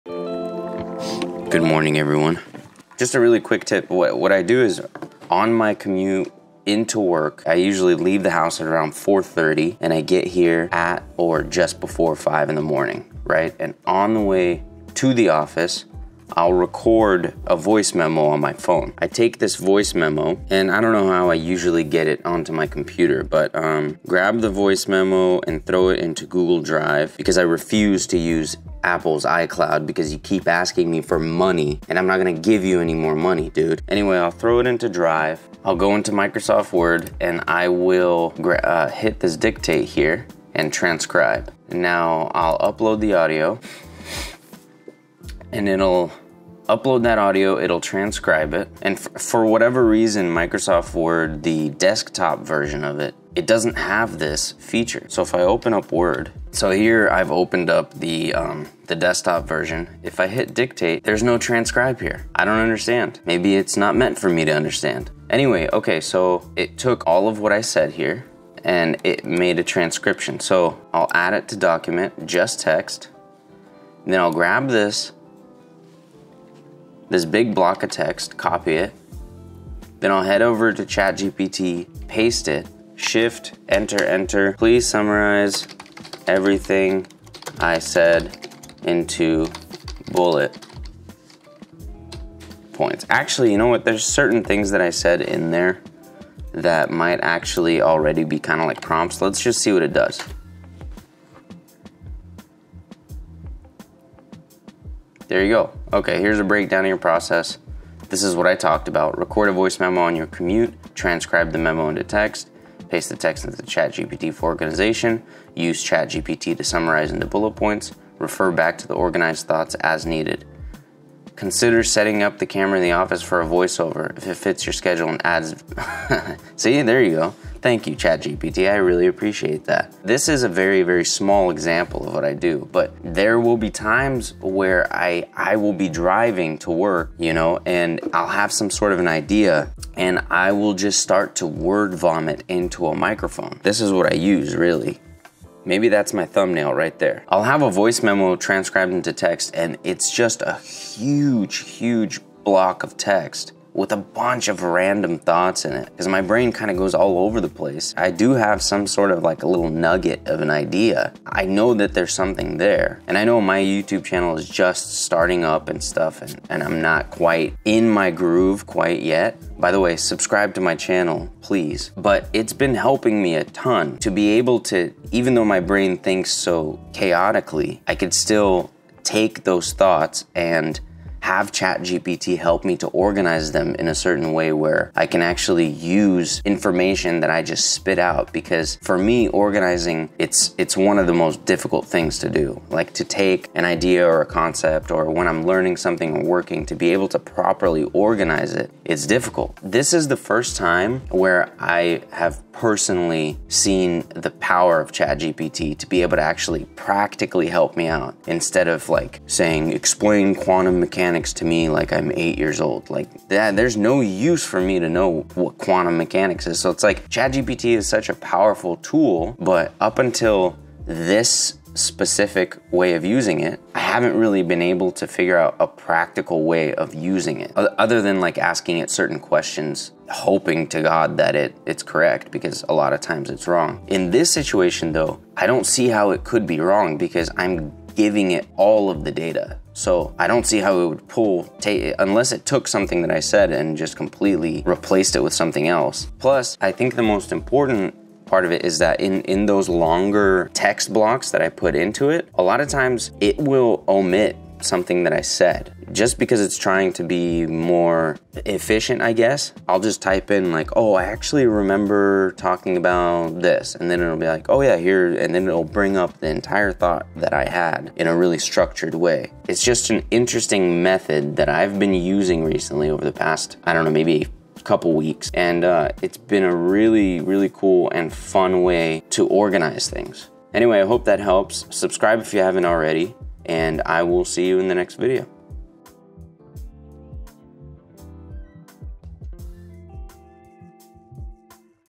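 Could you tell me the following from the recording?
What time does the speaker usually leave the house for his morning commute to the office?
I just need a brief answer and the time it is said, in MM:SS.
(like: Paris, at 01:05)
4:30, at 00:08.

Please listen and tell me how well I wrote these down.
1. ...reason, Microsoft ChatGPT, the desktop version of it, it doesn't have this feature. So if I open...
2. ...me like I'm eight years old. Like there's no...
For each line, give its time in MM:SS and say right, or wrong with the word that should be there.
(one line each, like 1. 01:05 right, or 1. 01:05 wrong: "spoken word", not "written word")
1. 00:49 wrong: "Word", not "ChatGPT"
2. 03:31 right.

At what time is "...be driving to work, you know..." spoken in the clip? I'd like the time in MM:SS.
02:15.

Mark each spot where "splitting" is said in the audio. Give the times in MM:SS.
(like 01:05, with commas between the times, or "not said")
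not said.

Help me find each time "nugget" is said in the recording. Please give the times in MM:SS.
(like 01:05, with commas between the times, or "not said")
02:39.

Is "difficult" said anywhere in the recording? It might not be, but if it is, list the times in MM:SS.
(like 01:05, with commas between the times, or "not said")
03:11, 03:19.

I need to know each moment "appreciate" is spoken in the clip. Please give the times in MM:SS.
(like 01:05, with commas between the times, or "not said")
02:09.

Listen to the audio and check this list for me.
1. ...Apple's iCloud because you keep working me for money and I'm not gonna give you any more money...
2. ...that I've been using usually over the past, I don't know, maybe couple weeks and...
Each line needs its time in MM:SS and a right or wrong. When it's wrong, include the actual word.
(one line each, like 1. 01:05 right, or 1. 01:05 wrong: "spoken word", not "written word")
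1. 00:28 wrong: "asking", not "working"
2. 04:31 wrong: "recently", not "usually".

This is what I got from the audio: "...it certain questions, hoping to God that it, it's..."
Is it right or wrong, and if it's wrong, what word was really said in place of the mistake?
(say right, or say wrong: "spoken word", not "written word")
right.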